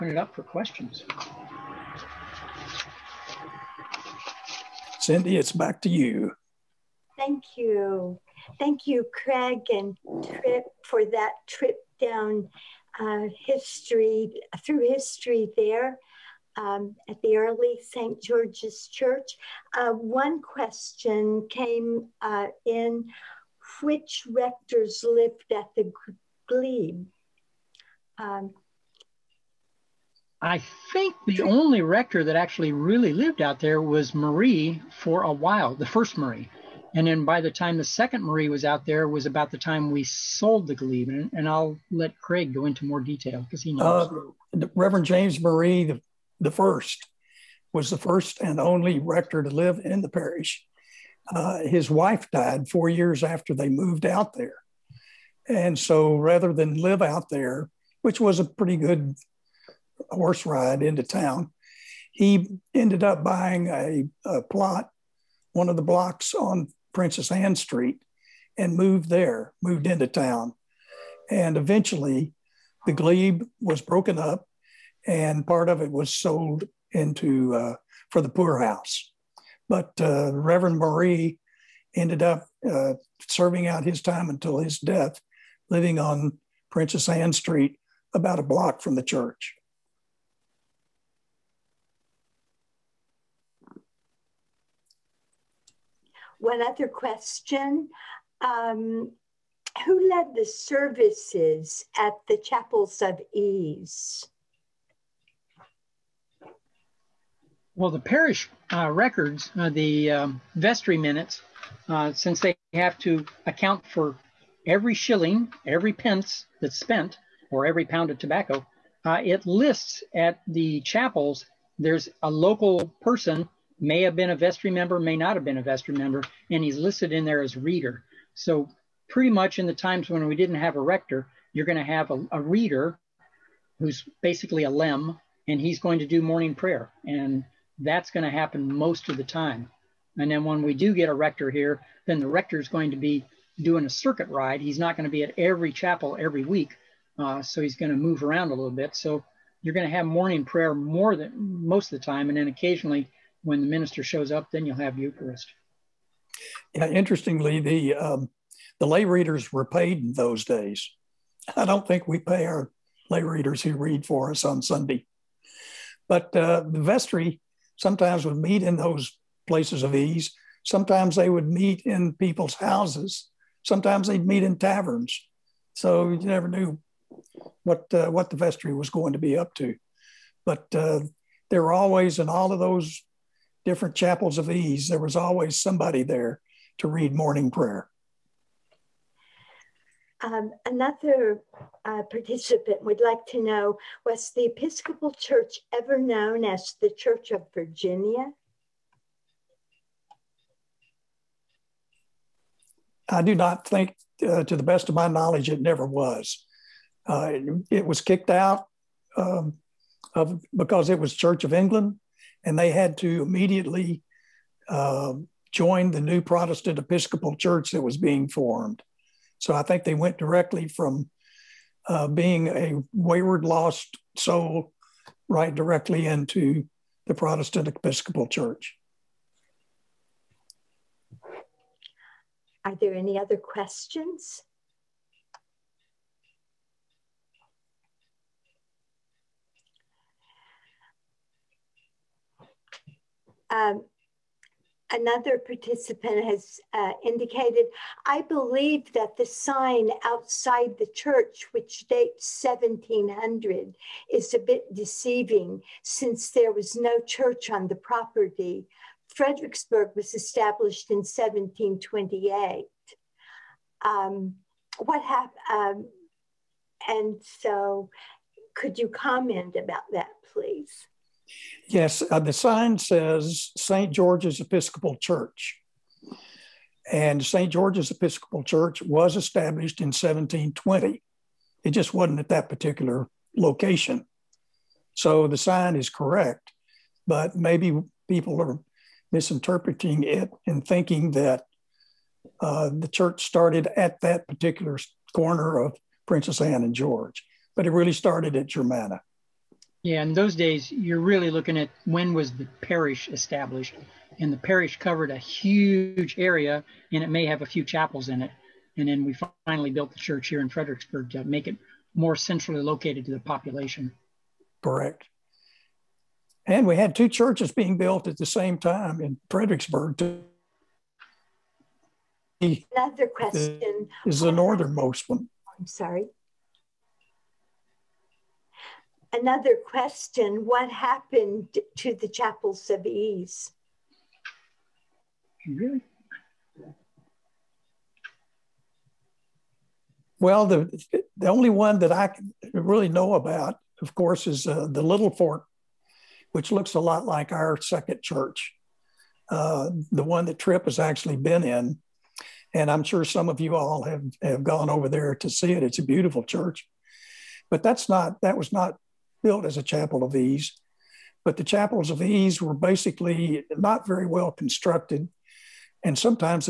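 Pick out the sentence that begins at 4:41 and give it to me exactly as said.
It just wasn't at that particular location.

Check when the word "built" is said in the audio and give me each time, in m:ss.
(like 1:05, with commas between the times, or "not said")
5:09, 5:17, 5:59.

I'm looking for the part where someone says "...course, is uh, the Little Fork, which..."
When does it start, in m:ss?
5:43.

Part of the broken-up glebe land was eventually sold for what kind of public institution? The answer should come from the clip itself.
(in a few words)
the poorhouse.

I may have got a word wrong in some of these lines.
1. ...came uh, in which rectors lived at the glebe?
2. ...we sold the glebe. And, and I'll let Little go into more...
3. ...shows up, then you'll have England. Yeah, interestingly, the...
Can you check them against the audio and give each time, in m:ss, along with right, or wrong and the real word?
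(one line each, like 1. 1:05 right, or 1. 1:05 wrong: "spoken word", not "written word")
1. 0:21 right
2. 0:39 wrong: "Craig", not "Little"
3. 2:34 wrong: "Eucharist", not "England".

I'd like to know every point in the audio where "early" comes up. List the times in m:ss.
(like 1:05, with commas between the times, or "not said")
0:17.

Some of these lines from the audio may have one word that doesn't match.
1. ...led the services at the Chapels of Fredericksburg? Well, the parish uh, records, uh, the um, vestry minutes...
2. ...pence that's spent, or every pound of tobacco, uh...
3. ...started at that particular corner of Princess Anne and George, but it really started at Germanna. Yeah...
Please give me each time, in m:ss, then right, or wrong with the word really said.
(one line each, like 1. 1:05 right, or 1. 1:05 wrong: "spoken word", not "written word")
1. 1:40 wrong: "Ease", not "Fredericksburg"
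2. 1:55 right
3. 4:53 right.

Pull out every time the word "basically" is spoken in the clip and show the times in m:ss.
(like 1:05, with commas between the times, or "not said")
2:14, 6:02.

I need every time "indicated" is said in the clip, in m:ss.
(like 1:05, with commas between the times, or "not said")
4:07.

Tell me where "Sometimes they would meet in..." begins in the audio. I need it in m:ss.
2:50.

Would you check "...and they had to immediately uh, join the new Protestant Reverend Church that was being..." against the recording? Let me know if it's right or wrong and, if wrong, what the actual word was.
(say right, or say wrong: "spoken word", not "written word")
wrong: "Episcopal", not "Reverend".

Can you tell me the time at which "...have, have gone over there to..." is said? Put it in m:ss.
5:53.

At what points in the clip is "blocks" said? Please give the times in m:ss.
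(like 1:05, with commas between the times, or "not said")
1:05, 1:28.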